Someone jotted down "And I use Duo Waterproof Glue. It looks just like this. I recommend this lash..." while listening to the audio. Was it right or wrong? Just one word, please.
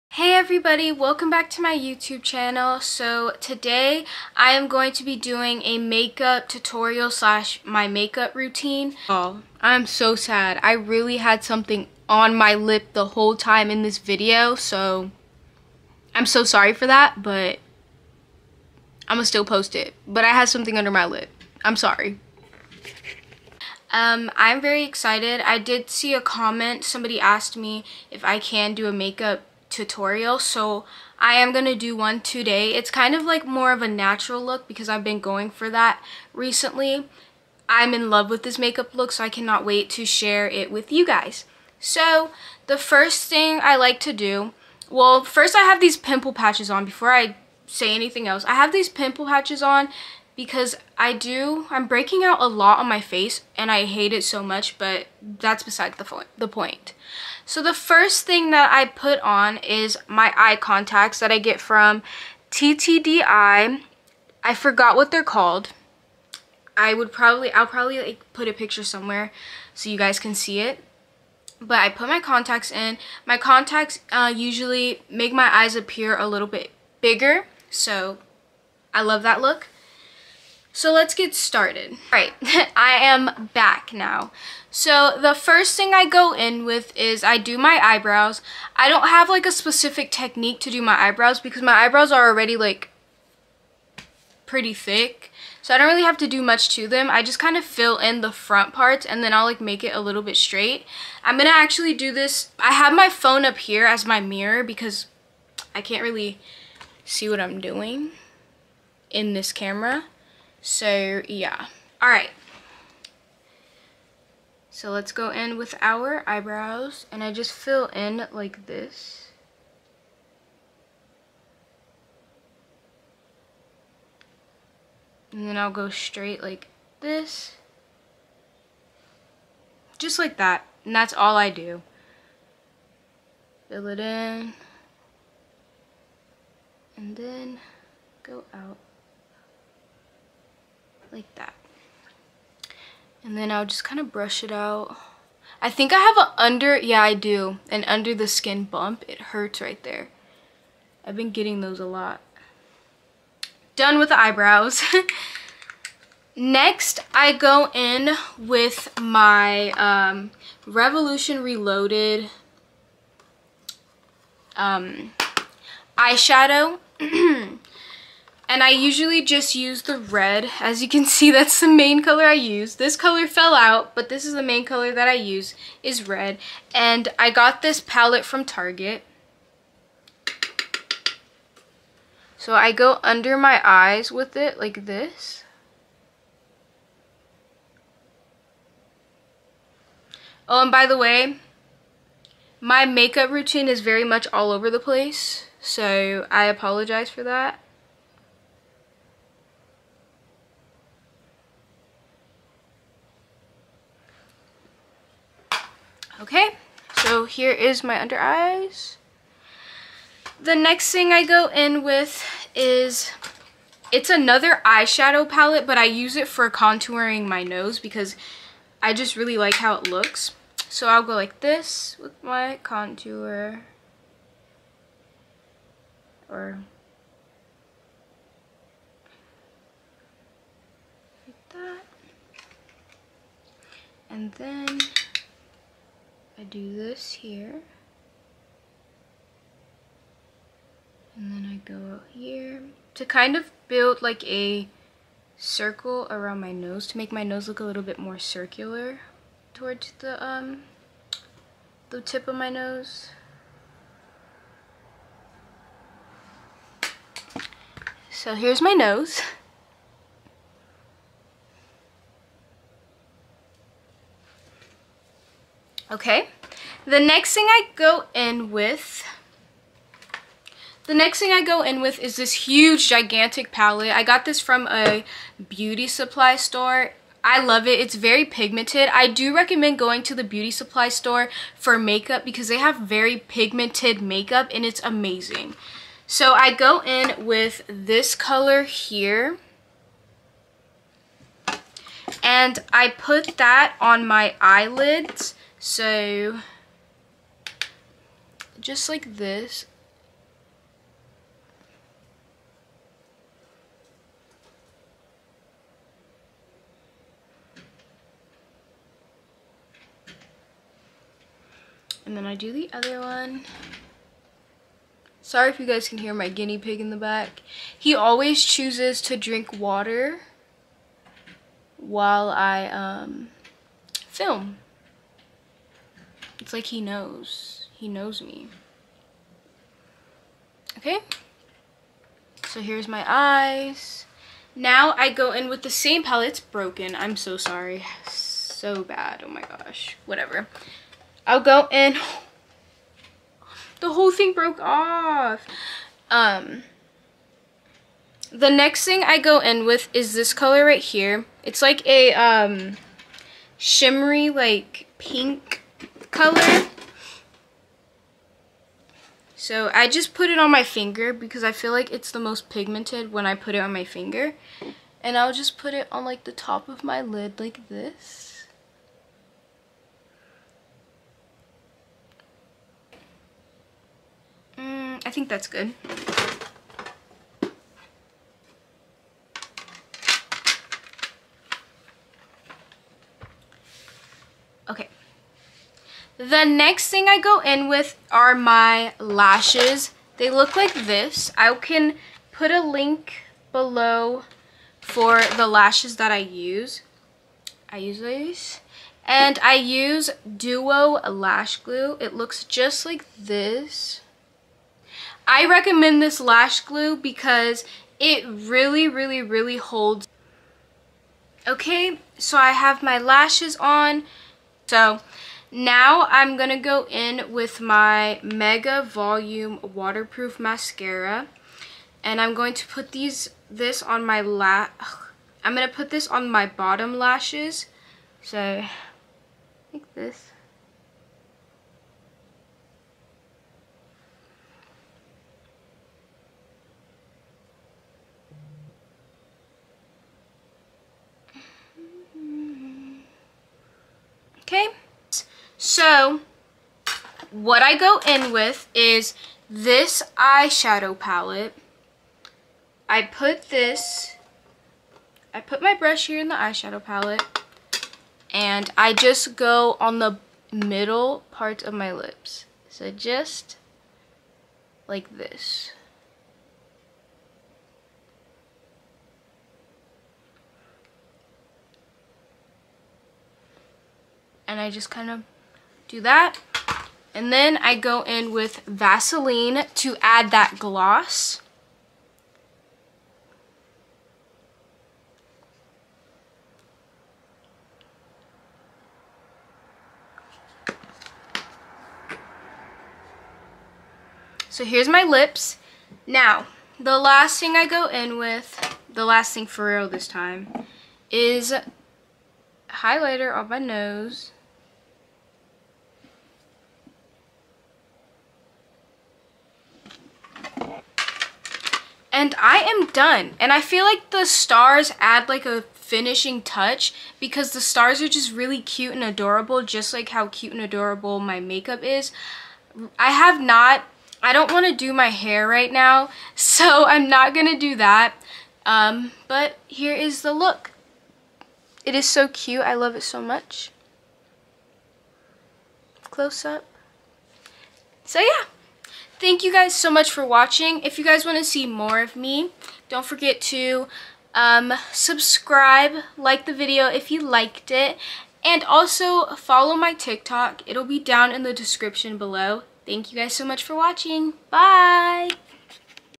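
wrong.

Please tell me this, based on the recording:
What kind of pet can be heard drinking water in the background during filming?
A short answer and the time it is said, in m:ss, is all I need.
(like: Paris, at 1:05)
Guinea pig, at 5:16.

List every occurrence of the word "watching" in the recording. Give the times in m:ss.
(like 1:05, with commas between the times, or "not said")
9:00, 9:13.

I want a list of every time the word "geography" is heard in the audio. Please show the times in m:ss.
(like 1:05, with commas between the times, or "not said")
not said.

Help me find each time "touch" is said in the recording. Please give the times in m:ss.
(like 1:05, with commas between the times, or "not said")
8:36.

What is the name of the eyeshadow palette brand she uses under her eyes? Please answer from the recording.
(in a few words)
Revolution Reloaded.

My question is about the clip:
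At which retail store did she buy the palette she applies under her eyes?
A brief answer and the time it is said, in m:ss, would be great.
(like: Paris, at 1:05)
Target, at 2:58.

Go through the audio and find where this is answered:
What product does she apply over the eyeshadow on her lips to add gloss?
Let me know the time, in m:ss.
7:58.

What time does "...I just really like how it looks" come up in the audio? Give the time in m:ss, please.
3:38.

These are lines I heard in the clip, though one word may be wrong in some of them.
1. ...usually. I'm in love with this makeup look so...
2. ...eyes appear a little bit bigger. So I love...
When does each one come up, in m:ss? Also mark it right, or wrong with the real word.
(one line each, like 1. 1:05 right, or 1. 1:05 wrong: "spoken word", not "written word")
1. 0:36 wrong: "recently", not "usually"
2. 1:15 right.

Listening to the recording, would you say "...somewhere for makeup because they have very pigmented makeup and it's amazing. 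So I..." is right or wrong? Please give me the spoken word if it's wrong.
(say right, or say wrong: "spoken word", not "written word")
wrong: "store", not "somewhere".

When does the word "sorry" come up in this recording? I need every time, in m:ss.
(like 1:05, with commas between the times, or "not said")
0:16, 0:21, 5:15, 5:37.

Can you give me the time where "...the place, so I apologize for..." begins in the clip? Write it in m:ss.
3:14.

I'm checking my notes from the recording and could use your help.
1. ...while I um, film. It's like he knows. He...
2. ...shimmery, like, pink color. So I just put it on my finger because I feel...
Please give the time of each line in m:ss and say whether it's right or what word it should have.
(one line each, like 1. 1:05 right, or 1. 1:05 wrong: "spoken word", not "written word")
1. 5:21 right
2. 5:53 right.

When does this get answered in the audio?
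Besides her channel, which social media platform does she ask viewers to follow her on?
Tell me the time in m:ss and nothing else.
9:09.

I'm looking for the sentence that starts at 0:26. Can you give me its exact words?
Somebody asked me if I can do a makeup tutorial so I am going to do one today.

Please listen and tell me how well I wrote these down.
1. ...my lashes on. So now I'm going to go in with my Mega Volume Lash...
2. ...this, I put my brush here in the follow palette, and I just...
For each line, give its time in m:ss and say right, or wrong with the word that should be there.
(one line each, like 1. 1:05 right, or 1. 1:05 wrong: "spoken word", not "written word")
1. 6:52 wrong: "Waterproof", not "Lash"
2. 7:33 wrong: "eyeshadow", not "follow".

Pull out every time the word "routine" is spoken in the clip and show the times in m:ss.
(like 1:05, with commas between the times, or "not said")
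0:08, 3:13.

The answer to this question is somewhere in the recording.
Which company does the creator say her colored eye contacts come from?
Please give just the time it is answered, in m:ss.
1:02.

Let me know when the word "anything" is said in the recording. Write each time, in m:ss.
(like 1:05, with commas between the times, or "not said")
0:47.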